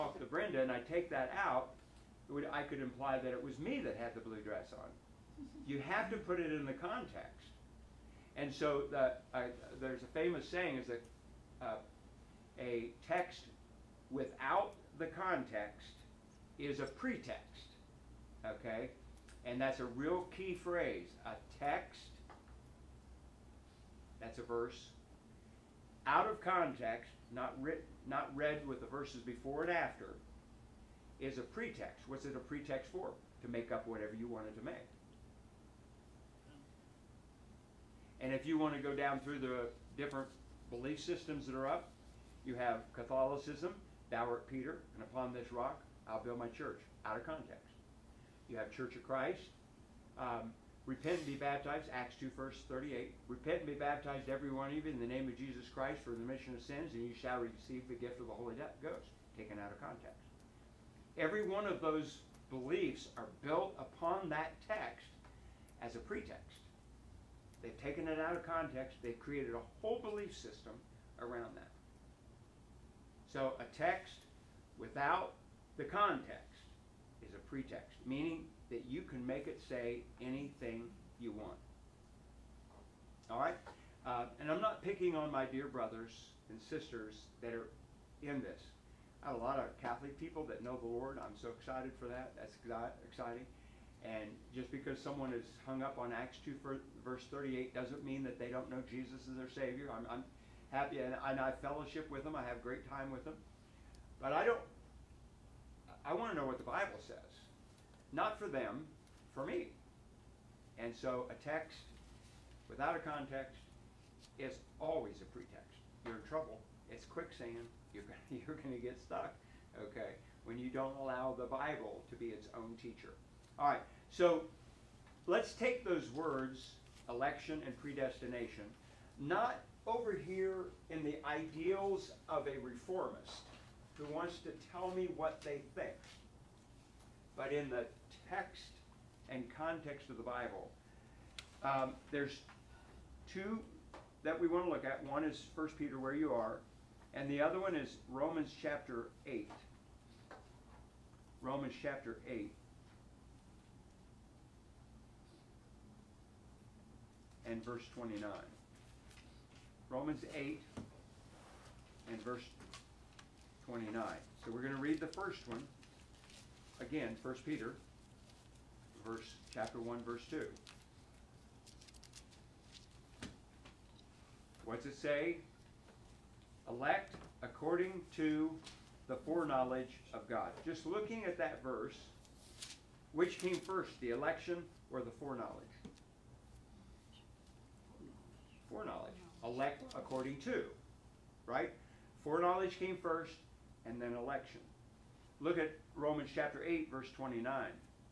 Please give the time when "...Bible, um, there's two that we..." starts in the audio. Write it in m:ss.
2:20.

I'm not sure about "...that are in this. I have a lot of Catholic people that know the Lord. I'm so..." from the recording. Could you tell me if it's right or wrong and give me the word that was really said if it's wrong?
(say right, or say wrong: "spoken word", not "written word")
right.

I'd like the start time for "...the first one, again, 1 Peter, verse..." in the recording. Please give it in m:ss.
2:44.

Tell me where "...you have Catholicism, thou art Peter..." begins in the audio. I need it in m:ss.
0:42.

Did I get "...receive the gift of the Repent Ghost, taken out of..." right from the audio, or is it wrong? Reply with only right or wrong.
wrong.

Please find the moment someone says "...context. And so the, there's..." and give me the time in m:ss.
0:06.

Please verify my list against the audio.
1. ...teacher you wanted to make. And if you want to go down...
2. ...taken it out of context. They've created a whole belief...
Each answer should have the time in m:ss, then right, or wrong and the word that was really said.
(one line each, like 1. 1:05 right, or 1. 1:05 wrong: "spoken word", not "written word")
1. 0:33 wrong: "whatever", not "teacher"
2. 1:07 right.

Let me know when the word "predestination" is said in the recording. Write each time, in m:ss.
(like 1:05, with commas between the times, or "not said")
2:07.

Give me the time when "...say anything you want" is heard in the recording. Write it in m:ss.
1:19.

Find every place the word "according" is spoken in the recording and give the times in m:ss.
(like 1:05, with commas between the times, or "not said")
2:57, 3:09.